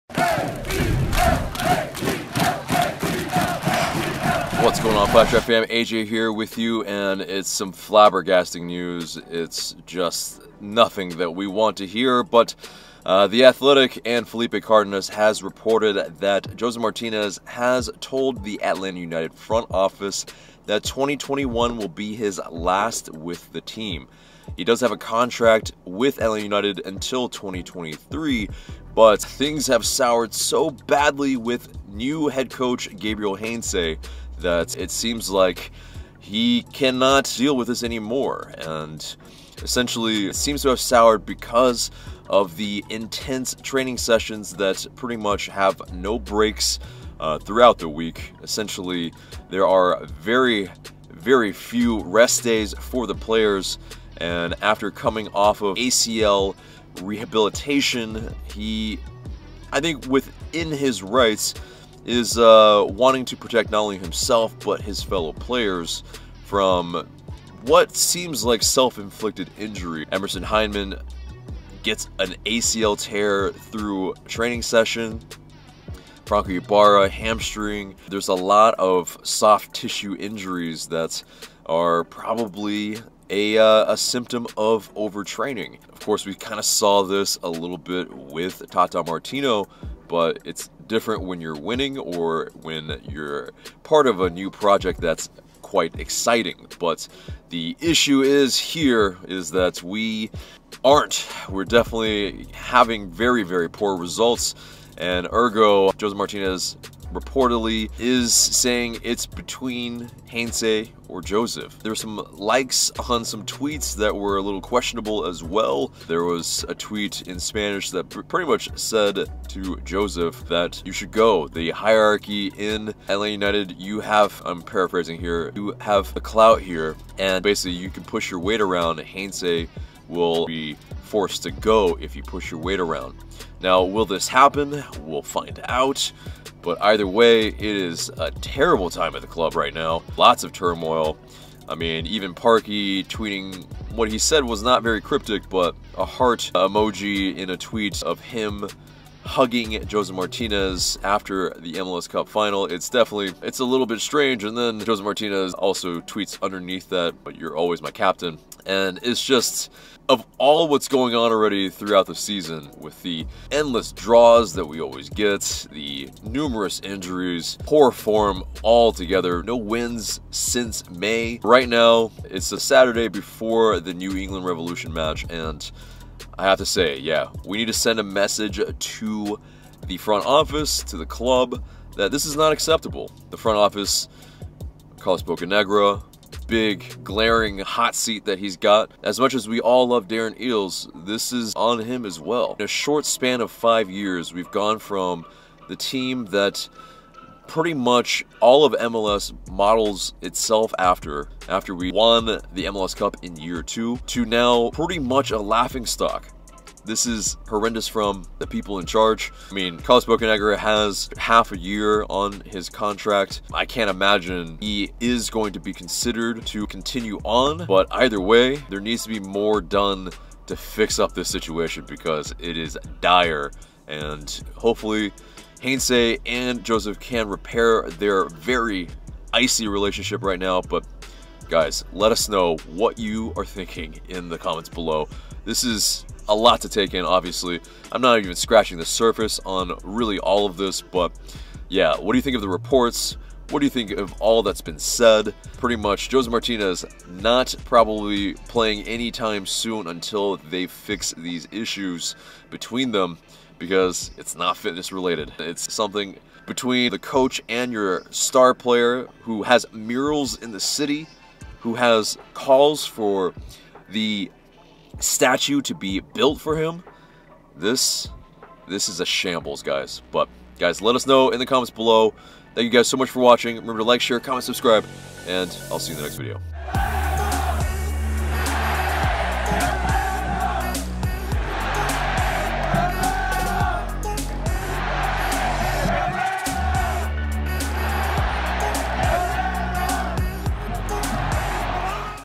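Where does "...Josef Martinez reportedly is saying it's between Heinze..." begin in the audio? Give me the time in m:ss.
1:45.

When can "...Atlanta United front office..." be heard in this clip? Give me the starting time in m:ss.
0:18.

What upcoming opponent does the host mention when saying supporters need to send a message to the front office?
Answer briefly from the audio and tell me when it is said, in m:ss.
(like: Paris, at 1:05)
New England Revolution, at 2:53.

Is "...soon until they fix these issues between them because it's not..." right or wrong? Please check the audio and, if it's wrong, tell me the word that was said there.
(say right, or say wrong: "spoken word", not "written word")
right.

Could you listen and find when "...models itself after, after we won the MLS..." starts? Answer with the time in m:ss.
3:19.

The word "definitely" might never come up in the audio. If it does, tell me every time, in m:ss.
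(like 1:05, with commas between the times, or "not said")
1:41, 2:32.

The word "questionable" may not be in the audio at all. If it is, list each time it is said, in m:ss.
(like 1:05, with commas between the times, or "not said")
1:54.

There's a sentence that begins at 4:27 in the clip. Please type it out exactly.
This, this is a shambles, guys.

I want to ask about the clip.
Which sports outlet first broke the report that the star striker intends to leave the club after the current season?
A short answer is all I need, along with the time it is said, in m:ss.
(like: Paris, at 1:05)
The Athletic, at 0:13.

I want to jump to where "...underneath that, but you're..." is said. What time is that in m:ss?
2:36.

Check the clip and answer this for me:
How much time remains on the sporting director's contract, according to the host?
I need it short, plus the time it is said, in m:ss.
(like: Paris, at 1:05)
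Half a year, at 3:31.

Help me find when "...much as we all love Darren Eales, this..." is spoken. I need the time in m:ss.
3:09.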